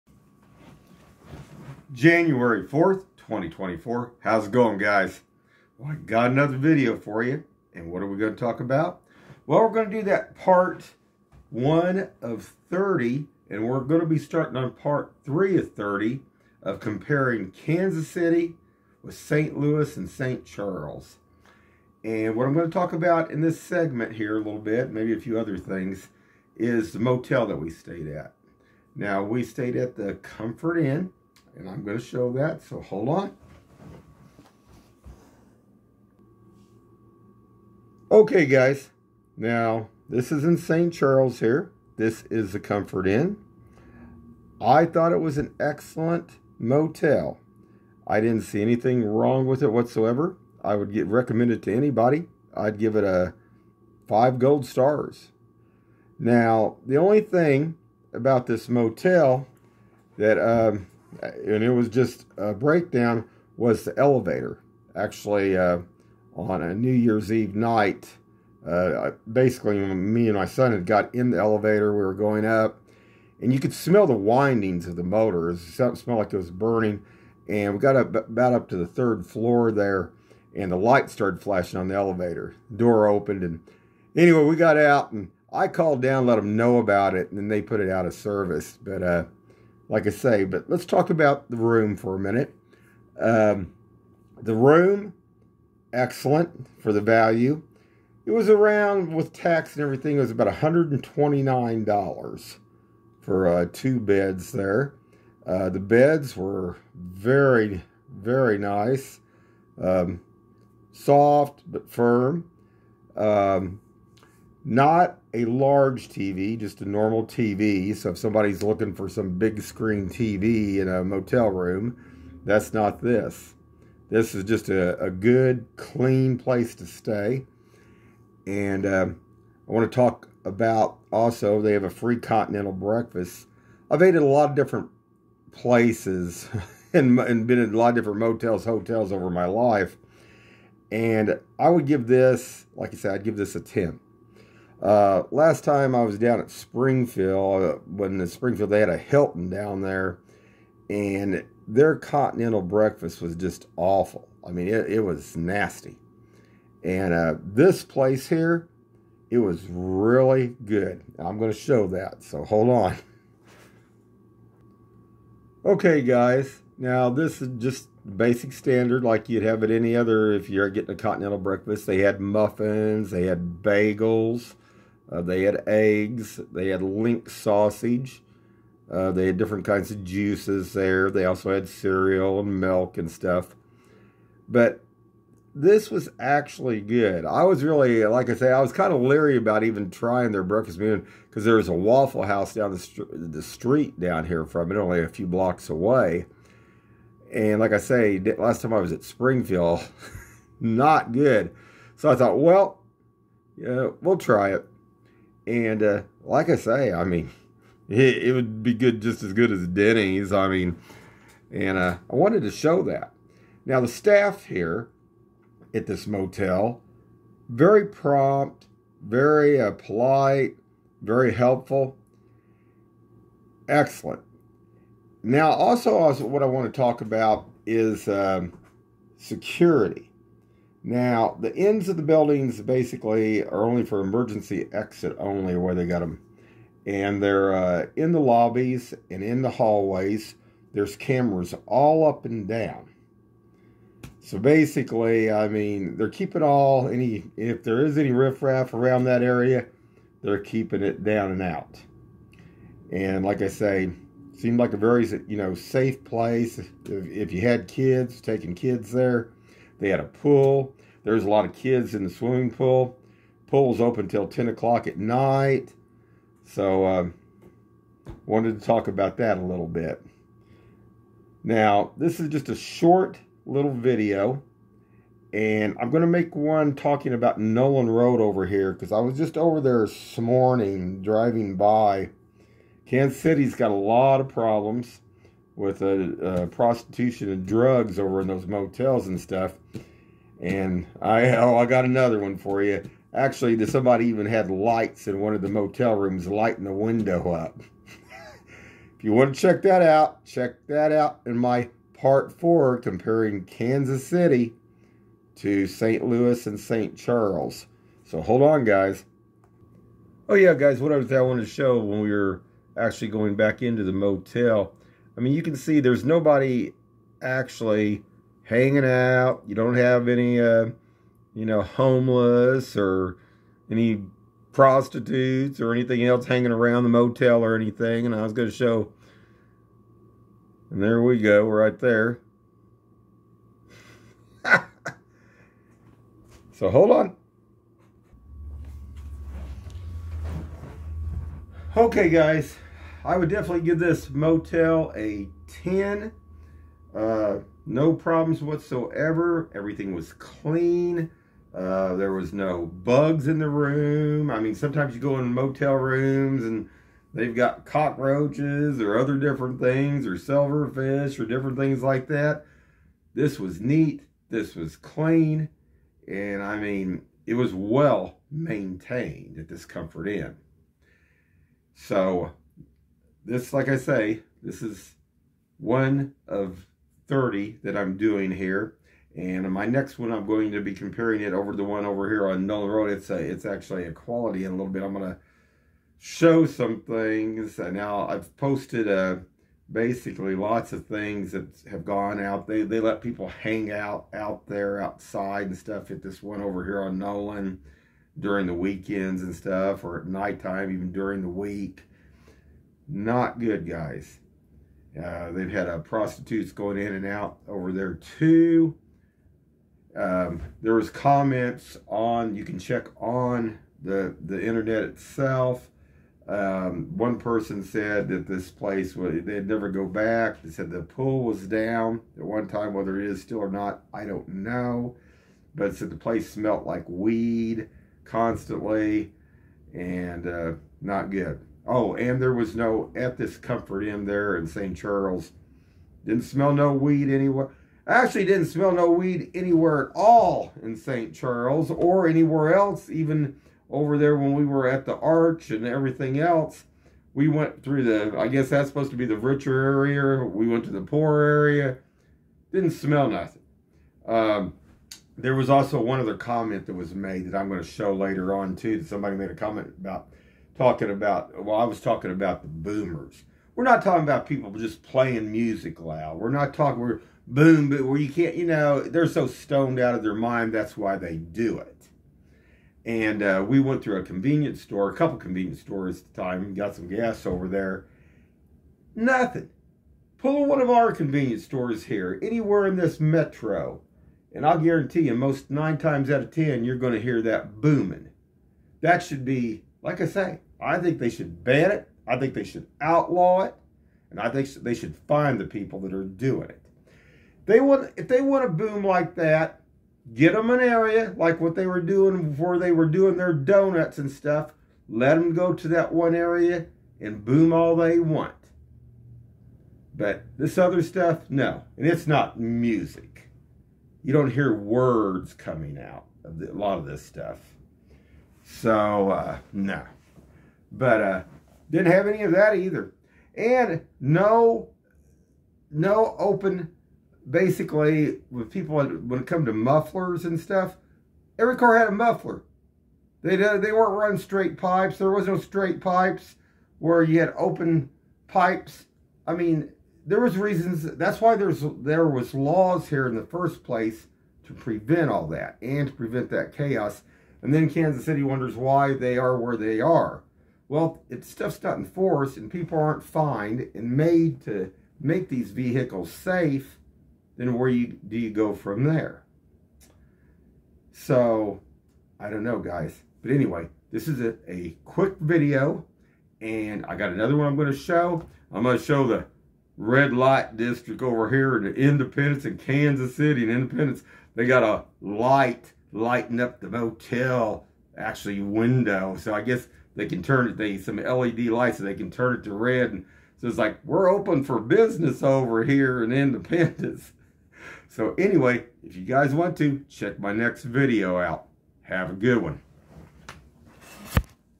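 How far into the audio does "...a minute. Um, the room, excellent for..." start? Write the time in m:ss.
1:32.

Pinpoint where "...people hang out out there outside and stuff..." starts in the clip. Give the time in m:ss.
6:33.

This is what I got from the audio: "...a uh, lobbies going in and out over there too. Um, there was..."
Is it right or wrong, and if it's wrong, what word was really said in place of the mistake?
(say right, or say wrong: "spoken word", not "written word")
wrong: "prostitutes", not "lobbies".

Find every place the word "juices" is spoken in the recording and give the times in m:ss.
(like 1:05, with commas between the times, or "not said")
3:00.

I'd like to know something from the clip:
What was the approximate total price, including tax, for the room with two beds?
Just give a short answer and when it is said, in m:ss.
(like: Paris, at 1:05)
$129, at 1:40.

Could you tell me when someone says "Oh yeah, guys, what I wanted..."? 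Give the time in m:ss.
5:10.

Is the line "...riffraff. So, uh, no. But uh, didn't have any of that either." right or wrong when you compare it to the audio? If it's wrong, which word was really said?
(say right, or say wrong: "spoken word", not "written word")
wrong: "stuff", not "riffraff".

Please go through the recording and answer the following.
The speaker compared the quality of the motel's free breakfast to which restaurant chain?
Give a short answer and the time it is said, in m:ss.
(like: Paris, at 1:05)
Denny's, at 3:29.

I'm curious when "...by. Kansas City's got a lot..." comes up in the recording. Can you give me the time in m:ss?
4:41.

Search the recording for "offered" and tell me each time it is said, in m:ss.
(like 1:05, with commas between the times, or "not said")
not said.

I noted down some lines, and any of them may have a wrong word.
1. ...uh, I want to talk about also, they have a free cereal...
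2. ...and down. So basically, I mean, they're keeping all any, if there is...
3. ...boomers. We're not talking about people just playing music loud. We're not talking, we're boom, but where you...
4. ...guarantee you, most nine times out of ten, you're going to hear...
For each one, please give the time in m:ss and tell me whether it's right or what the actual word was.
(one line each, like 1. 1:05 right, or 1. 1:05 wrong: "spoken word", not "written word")
1. 2:08 wrong: "continental", not "cereal"
2. 4:02 right
3. 7:42 right
4. 8:04 right.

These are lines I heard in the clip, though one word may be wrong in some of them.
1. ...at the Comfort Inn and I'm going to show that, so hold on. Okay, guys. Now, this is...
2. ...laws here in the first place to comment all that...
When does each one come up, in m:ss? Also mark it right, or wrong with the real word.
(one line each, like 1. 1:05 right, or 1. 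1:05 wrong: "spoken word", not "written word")
1. 0:29 right
2. 9:02 wrong: "prevent", not "comment".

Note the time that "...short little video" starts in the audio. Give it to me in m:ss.
4:32.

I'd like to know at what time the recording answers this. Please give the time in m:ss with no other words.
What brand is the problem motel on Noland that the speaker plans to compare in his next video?
6:23.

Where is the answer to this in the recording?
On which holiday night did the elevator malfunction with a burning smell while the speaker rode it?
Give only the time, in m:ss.
1:06.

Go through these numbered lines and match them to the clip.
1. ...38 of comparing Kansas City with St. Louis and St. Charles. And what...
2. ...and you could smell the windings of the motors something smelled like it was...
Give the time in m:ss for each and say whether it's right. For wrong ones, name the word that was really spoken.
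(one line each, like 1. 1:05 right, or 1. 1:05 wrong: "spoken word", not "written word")
1. 0:15 wrong: "30", not "38"
2. 1:13 right.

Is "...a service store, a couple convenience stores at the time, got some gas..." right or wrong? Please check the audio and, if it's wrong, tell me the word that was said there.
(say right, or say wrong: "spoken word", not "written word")
wrong: "convenience", not "service".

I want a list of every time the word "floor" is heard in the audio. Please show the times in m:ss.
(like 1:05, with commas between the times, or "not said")
1:19.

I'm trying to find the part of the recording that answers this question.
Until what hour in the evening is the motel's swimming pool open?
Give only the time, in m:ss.
4:24.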